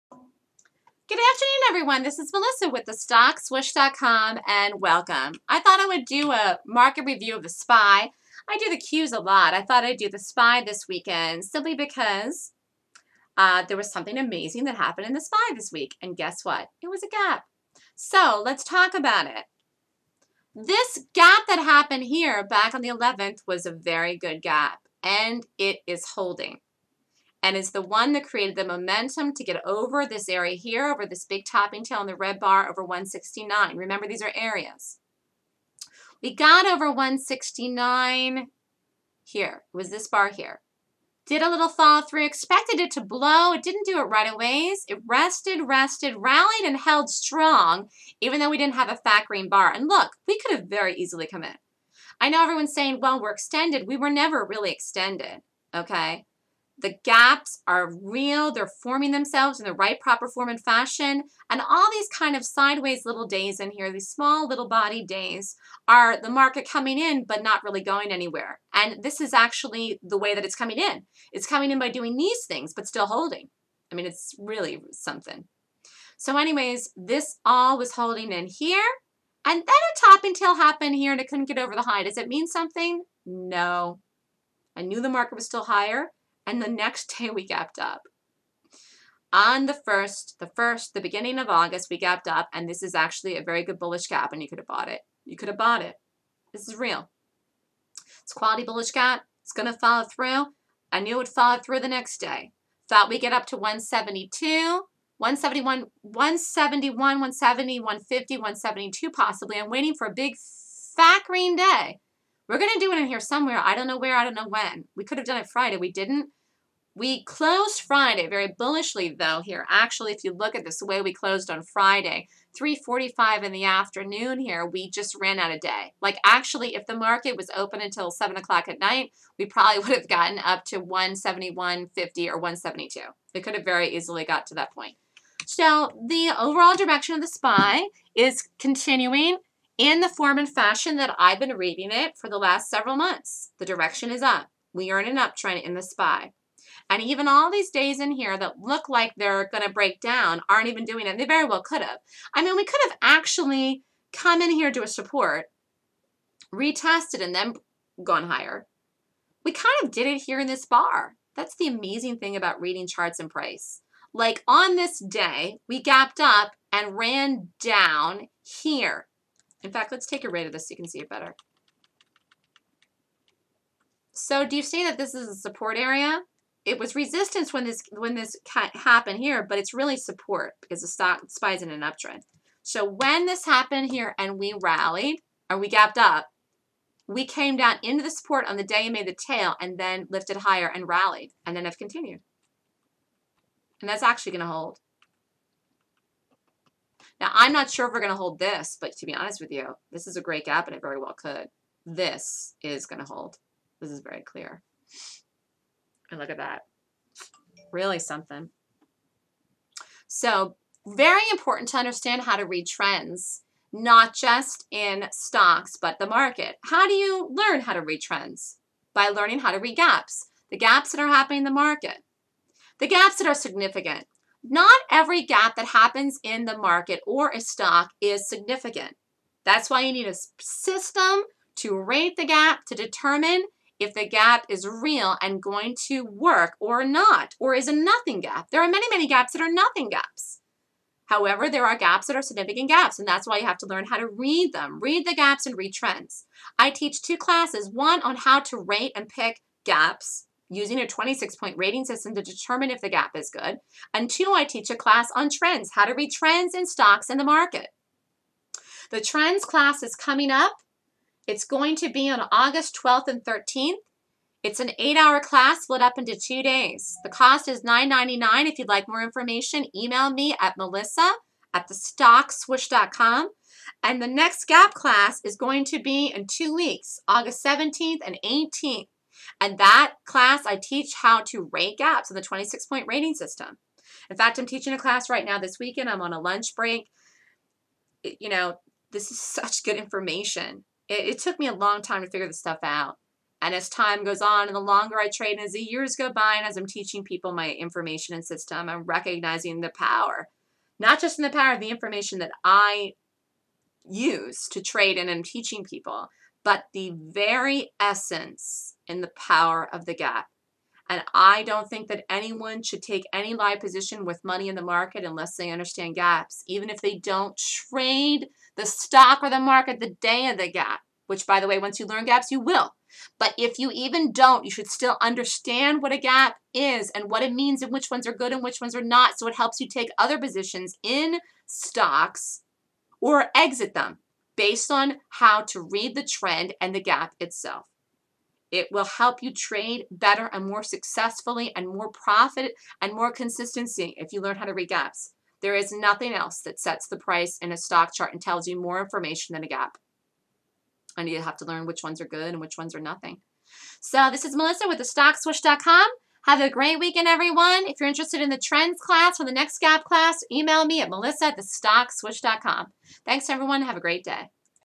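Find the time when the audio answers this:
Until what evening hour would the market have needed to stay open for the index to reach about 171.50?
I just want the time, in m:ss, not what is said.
2:08.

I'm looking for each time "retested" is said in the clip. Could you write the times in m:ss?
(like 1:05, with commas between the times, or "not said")
2:36.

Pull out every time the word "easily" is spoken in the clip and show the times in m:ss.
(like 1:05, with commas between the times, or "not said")
0:50, 2:13.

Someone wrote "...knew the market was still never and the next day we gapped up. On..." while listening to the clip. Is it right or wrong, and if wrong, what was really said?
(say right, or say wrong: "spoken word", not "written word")
wrong: "higher", not "never".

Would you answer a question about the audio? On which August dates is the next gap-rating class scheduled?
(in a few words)
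August 17th and 18th.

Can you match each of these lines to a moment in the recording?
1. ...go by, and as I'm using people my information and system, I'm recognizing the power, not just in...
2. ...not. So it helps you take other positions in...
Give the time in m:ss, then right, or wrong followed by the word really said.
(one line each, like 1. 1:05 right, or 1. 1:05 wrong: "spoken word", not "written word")
1. 4:55 wrong: "teaching", not "using"
2. 5:28 right.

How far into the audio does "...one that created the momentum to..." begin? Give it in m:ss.
0:27.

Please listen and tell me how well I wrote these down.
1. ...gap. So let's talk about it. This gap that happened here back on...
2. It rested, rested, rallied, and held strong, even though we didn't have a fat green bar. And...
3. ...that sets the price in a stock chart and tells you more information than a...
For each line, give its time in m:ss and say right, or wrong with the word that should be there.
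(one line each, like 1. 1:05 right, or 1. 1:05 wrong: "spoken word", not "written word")
1. 0:17 right
2. 0:44 right
3. 5:46 right.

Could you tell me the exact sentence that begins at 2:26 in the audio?
And even all these days in here that look like they're going to break down aren't even doing it.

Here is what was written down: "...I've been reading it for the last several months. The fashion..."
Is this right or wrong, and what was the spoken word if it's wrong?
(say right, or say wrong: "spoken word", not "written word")
wrong: "direction", not "fashion".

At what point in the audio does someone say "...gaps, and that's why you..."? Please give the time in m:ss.
4:02.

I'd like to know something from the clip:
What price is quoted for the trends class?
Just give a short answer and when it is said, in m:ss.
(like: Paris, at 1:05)
$9.99, at 4:27.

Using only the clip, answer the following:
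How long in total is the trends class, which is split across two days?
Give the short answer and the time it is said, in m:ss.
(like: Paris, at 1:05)
8 hours, at 4:24.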